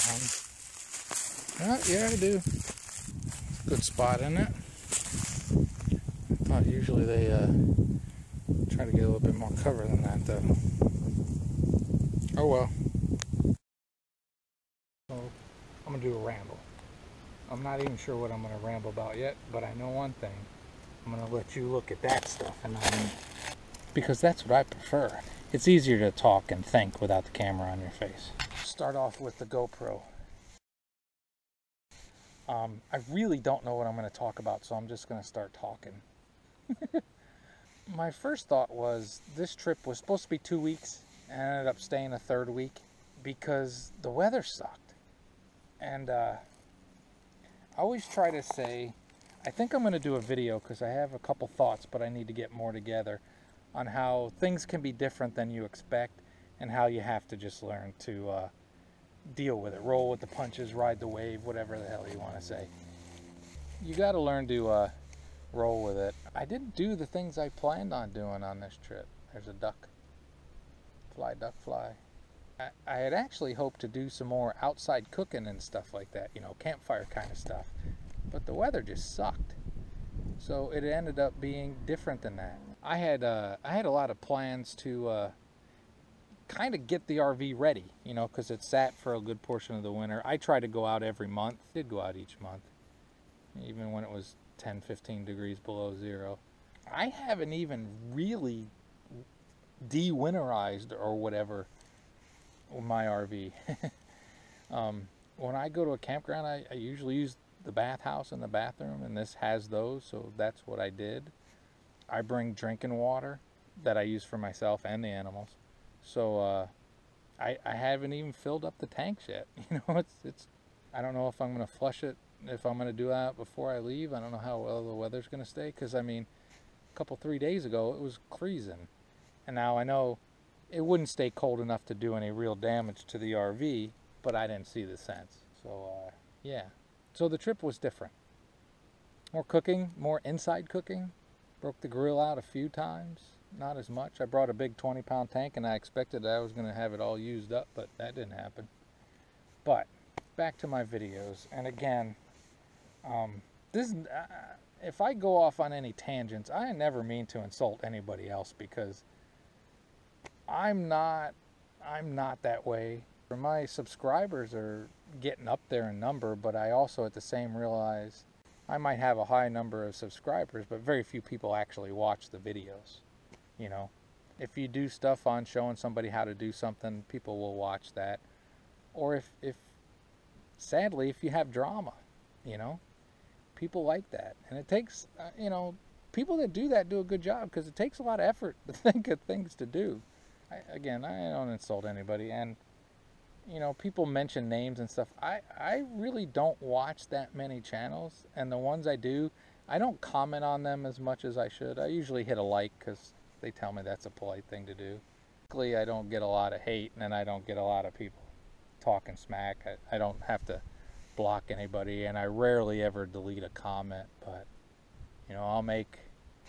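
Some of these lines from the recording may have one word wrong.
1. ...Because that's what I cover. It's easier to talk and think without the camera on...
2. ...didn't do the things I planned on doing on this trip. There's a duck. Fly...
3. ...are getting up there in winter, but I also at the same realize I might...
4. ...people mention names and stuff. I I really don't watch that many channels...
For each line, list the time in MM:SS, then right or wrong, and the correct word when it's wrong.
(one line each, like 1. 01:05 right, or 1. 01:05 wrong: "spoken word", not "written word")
1. 00:23 wrong: "prefer", not "cover"
2. 01:06 right
3. 02:44 wrong: "number", not "winter"
4. 03:13 right.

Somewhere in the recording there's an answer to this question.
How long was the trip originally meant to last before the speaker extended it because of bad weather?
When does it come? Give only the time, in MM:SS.
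00:40.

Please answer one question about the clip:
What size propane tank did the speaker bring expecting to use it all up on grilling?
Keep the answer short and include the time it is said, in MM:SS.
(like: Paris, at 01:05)
20 pound, at 02:24.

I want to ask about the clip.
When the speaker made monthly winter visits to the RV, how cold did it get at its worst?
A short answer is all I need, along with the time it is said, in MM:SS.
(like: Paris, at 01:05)
10 to 15 degrees below zero, at 01:34.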